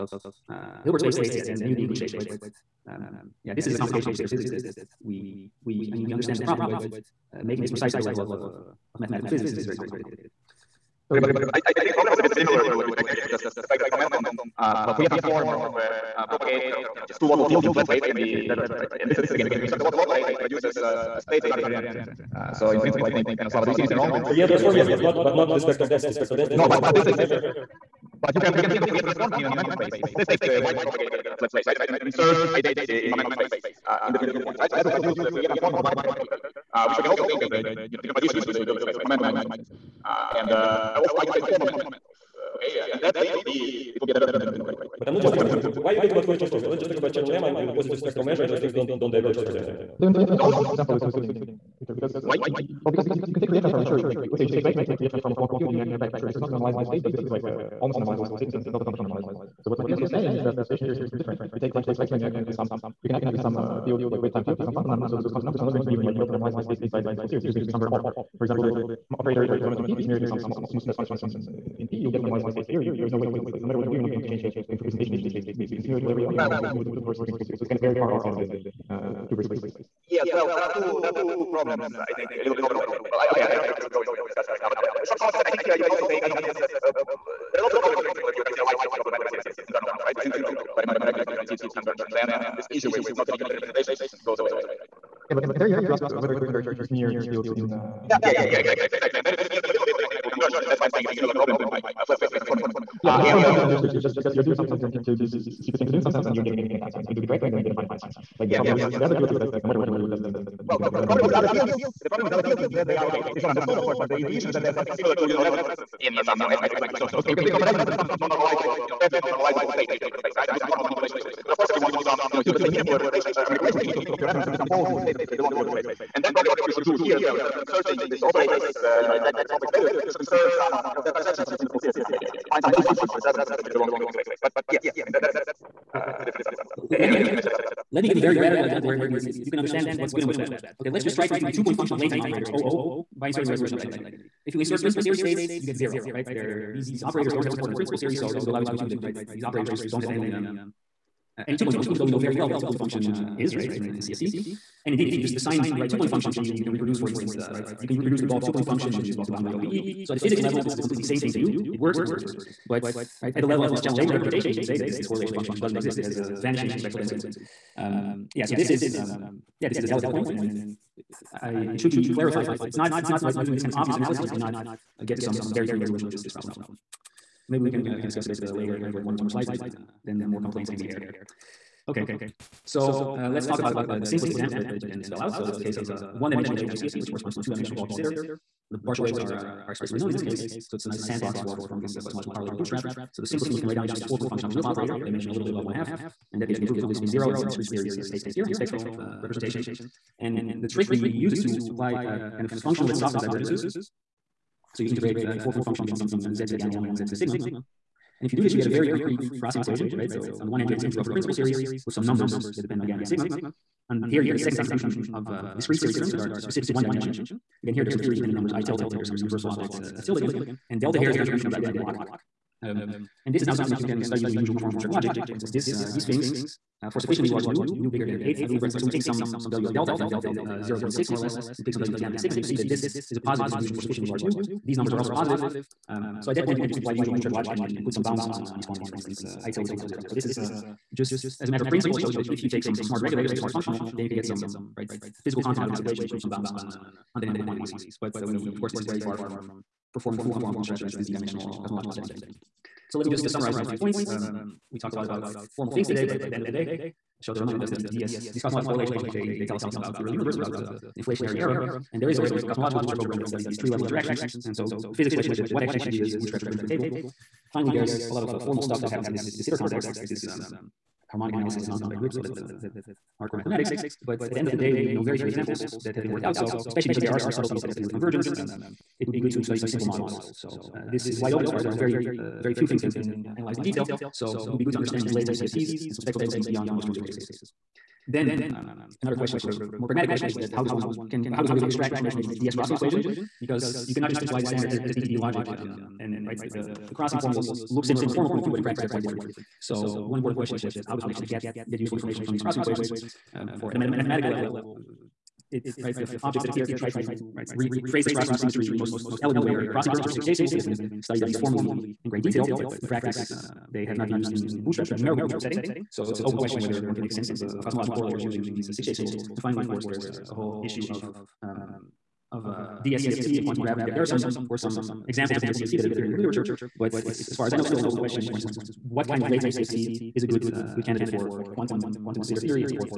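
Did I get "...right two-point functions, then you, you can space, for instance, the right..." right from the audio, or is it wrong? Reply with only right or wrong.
wrong.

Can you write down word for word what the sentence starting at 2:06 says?
And that's probably what you should do here as well.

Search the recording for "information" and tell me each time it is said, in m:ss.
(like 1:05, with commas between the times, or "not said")
4:51, 5:01.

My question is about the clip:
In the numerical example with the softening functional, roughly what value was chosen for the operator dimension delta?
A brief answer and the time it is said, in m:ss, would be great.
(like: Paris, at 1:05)
0.6, at 3:50.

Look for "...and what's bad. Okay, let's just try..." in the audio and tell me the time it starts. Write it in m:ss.
2:20.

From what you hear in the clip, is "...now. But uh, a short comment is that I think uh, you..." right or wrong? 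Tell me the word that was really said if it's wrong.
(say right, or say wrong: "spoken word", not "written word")
right.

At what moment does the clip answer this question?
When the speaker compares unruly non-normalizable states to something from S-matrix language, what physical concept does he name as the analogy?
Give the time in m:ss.
1:55.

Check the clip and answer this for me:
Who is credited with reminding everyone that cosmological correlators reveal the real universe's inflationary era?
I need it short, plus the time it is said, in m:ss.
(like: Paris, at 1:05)
Shota, at 4:17.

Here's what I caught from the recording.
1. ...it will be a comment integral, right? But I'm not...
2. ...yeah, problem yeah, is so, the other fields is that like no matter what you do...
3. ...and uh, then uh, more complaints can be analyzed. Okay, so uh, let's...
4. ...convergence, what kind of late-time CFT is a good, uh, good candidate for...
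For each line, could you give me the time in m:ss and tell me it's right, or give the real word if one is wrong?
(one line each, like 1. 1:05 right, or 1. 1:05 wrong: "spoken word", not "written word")
1. 0:43 wrong: "divergent", not "comment"
2. 1:48 right
3. 2:59 wrong: "aired", not "analyzed"
4. 5:28 wrong: "instance", not "convergence".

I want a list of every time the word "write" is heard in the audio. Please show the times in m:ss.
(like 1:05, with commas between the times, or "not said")
3:13.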